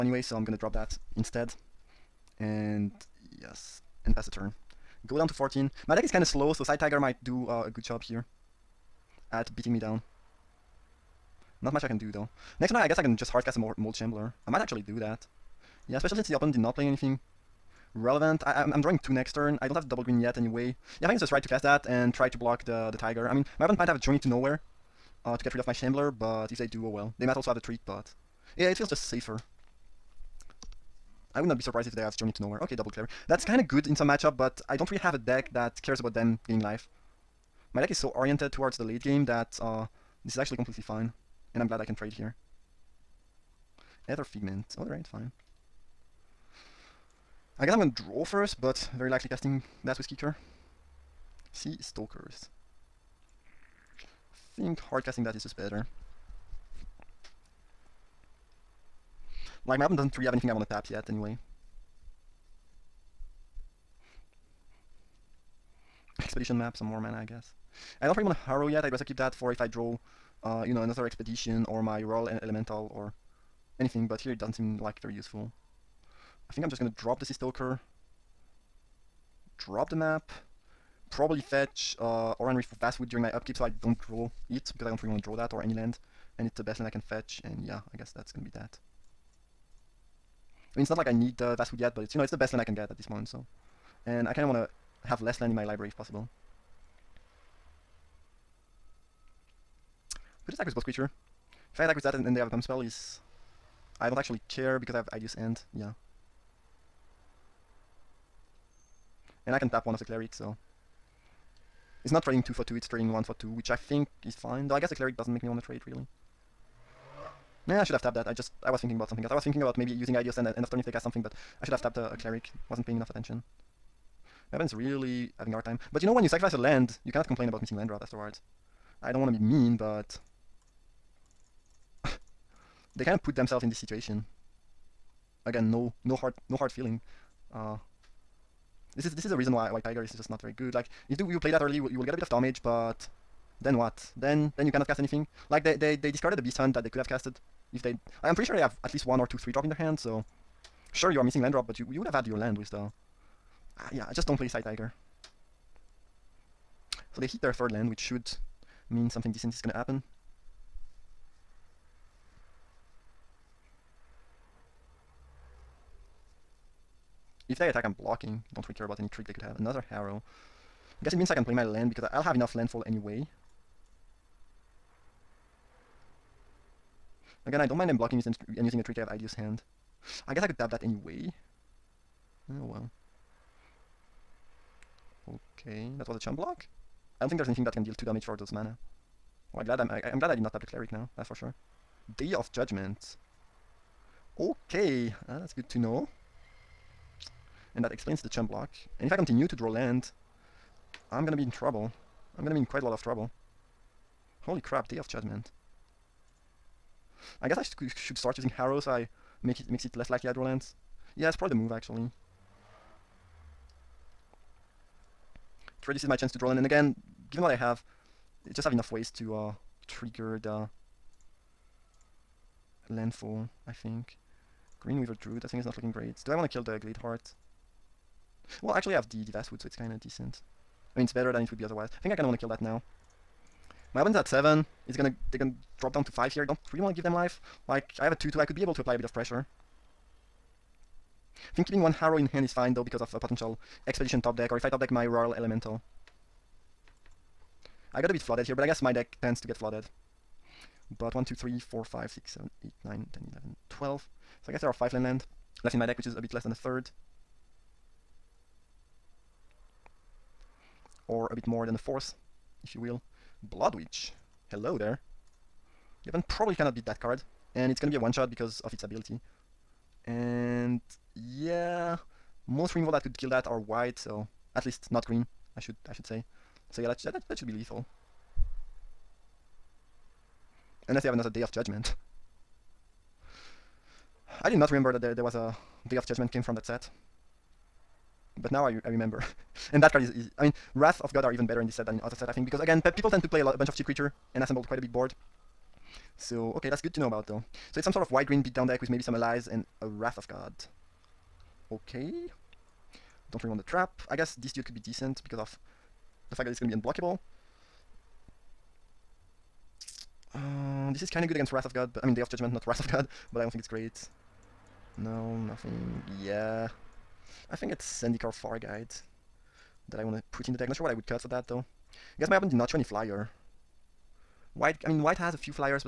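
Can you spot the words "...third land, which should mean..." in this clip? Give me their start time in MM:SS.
02:37.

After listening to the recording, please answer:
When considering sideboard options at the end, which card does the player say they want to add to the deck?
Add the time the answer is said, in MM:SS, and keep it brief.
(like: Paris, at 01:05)
Zendikar Guide, at 05:18.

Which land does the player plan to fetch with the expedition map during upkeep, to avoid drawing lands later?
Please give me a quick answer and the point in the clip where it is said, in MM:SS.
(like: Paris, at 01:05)
Oran-Rief, at 01:22.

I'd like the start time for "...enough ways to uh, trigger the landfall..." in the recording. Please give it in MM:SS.
03:38.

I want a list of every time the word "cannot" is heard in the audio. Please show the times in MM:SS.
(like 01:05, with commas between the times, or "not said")
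02:07, 02:24, 04:26.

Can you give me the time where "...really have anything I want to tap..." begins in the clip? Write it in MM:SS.
01:00.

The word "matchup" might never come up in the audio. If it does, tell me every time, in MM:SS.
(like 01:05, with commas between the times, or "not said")
00:34.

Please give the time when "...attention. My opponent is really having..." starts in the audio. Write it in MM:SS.
02:03.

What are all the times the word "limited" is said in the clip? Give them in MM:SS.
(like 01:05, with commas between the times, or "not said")
not said.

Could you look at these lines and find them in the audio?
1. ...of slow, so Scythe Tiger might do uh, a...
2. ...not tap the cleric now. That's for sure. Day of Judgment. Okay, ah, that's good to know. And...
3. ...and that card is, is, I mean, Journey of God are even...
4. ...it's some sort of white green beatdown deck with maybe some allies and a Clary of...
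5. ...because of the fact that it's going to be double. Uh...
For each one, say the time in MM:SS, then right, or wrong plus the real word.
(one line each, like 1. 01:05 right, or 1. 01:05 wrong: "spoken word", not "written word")
1. 00:06 right
2. 03:10 right
3. 04:49 wrong: "Wrath", not "Journey"
4. 04:57 wrong: "Wrath", not "Clary"
5. 05:05 wrong: "unblockable", not "double".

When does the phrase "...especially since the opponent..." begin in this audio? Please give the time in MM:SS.
00:15.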